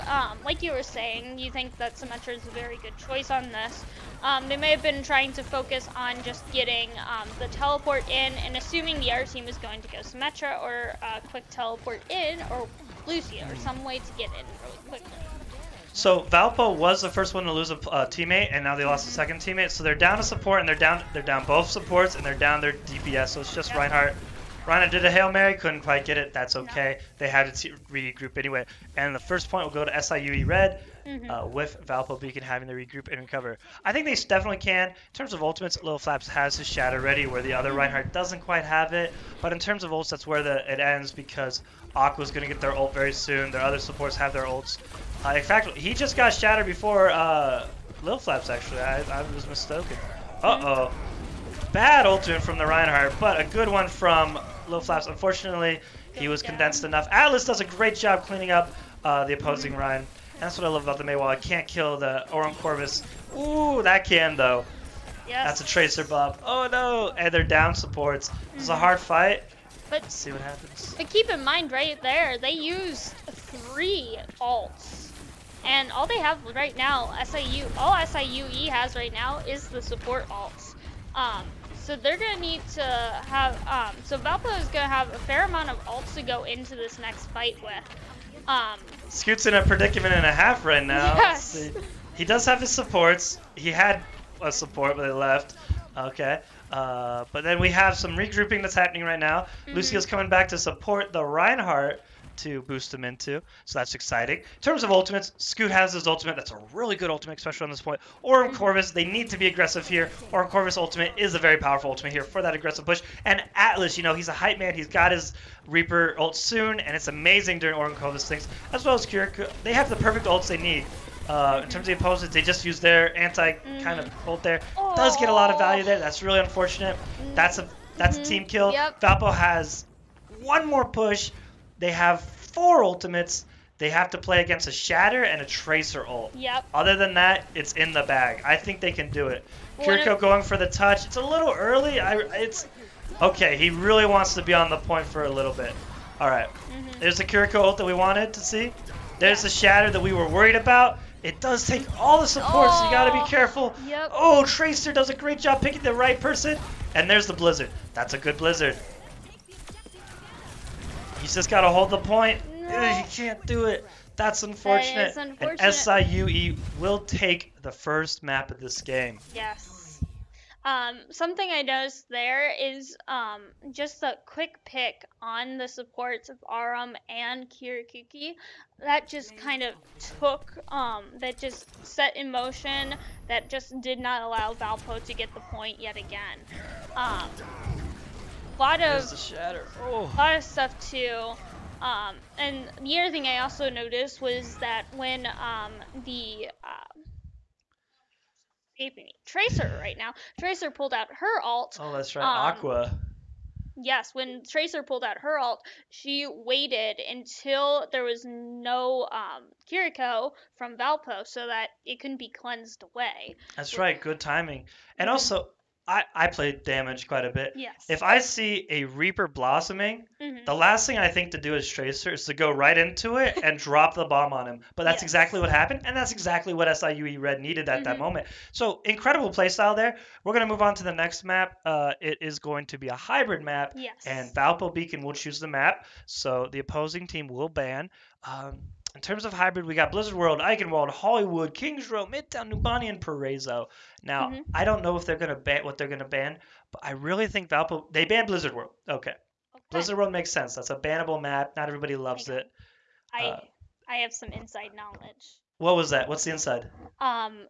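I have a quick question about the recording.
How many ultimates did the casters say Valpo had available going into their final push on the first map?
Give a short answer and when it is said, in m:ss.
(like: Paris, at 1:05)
4, at 2:12.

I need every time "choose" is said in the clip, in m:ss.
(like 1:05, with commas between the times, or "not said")
3:55.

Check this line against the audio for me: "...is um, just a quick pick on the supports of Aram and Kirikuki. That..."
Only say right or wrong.
right.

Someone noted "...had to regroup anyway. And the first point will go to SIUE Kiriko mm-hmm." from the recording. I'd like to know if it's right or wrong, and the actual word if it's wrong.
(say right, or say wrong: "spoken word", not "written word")
wrong: "Red", not "Kiriko".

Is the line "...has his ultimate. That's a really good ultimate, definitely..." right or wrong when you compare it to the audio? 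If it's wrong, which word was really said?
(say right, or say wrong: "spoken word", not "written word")
wrong: "especially", not "definitely".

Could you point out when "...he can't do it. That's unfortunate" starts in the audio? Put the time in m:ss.
2:43.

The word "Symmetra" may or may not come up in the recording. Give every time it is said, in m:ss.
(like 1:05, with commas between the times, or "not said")
0:01, 0:09.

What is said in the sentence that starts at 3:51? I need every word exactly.
Uh, it is going to be a hybrid map.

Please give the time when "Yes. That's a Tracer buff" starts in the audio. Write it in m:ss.
1:05.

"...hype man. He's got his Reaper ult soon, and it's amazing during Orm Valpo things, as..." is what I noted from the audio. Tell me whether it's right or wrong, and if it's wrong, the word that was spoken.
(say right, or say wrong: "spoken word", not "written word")
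wrong: "Corvus", not "Valpo".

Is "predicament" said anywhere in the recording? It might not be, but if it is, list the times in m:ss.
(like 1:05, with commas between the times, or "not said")
1:29.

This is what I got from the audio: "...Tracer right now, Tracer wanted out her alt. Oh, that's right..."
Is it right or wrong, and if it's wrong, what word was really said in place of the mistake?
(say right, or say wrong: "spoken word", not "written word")
wrong: "pulled", not "wanted".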